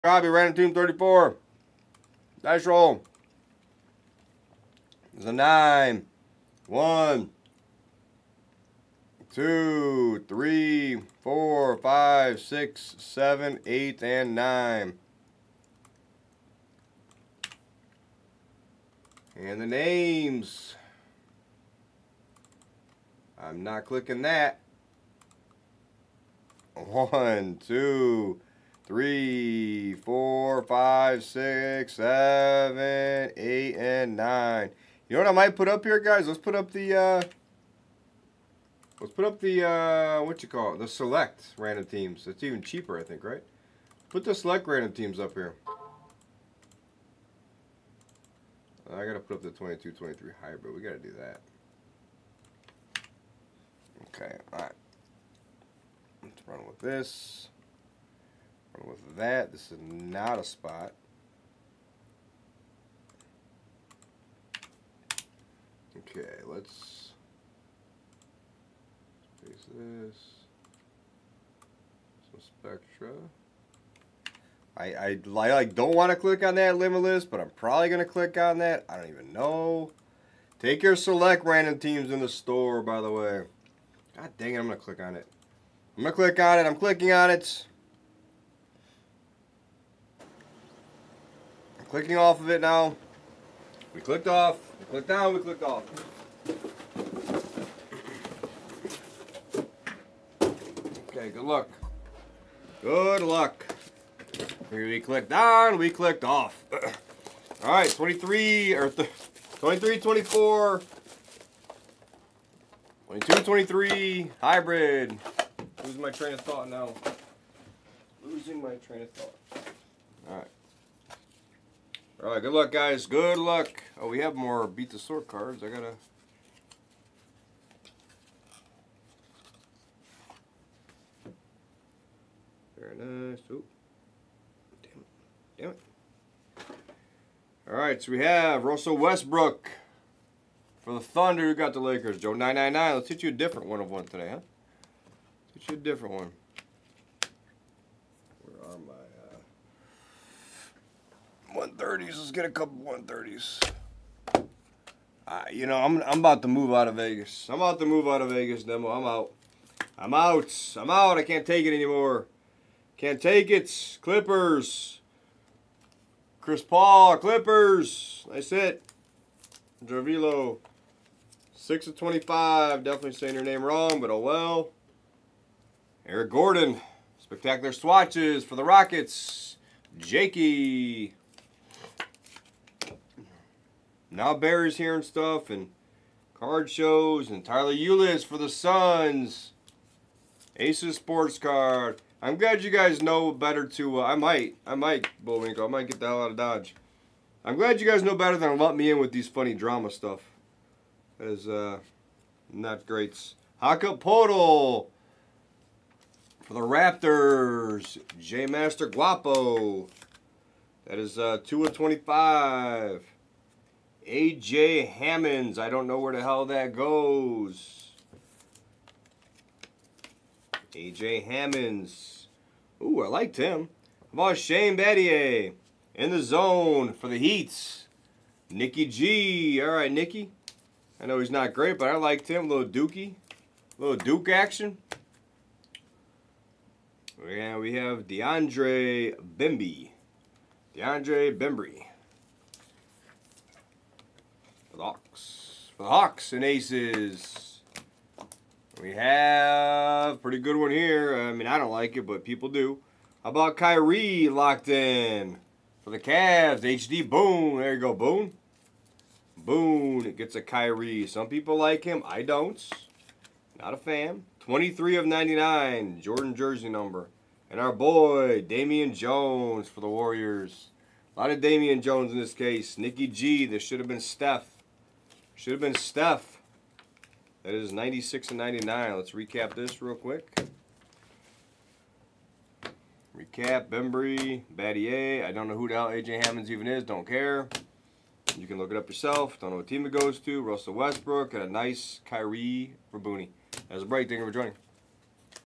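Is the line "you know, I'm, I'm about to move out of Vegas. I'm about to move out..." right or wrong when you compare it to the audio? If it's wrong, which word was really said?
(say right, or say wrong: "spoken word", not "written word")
right.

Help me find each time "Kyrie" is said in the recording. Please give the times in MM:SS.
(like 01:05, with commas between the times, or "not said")
04:13, 04:20, 04:52.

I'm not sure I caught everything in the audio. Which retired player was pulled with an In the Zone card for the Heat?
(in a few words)
Shane Battier.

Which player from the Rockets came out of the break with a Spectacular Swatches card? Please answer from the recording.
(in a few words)
Eric Gordon.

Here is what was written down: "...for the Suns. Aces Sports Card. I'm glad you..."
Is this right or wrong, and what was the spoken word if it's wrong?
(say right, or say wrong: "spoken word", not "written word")
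right.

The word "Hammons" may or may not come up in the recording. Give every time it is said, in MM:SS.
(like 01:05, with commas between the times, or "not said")
03:34, 03:41, 04:46.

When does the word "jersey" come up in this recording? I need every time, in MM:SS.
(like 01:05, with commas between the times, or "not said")
04:26.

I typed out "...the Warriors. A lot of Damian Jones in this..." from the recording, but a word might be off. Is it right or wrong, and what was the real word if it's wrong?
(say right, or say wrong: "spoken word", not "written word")
right.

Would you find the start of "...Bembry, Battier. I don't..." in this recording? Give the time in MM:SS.
04:43.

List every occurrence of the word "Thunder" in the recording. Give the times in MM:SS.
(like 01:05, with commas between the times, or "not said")
02:20.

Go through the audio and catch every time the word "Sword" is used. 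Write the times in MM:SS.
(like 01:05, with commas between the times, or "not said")
02:04.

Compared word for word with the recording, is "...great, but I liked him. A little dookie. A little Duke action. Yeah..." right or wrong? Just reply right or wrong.
right.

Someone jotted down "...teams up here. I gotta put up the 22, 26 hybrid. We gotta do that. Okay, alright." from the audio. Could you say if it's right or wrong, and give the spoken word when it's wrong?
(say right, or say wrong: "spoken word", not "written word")
wrong: "23", not "26".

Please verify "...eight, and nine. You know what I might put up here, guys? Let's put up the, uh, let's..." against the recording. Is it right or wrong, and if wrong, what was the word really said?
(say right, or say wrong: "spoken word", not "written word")
right.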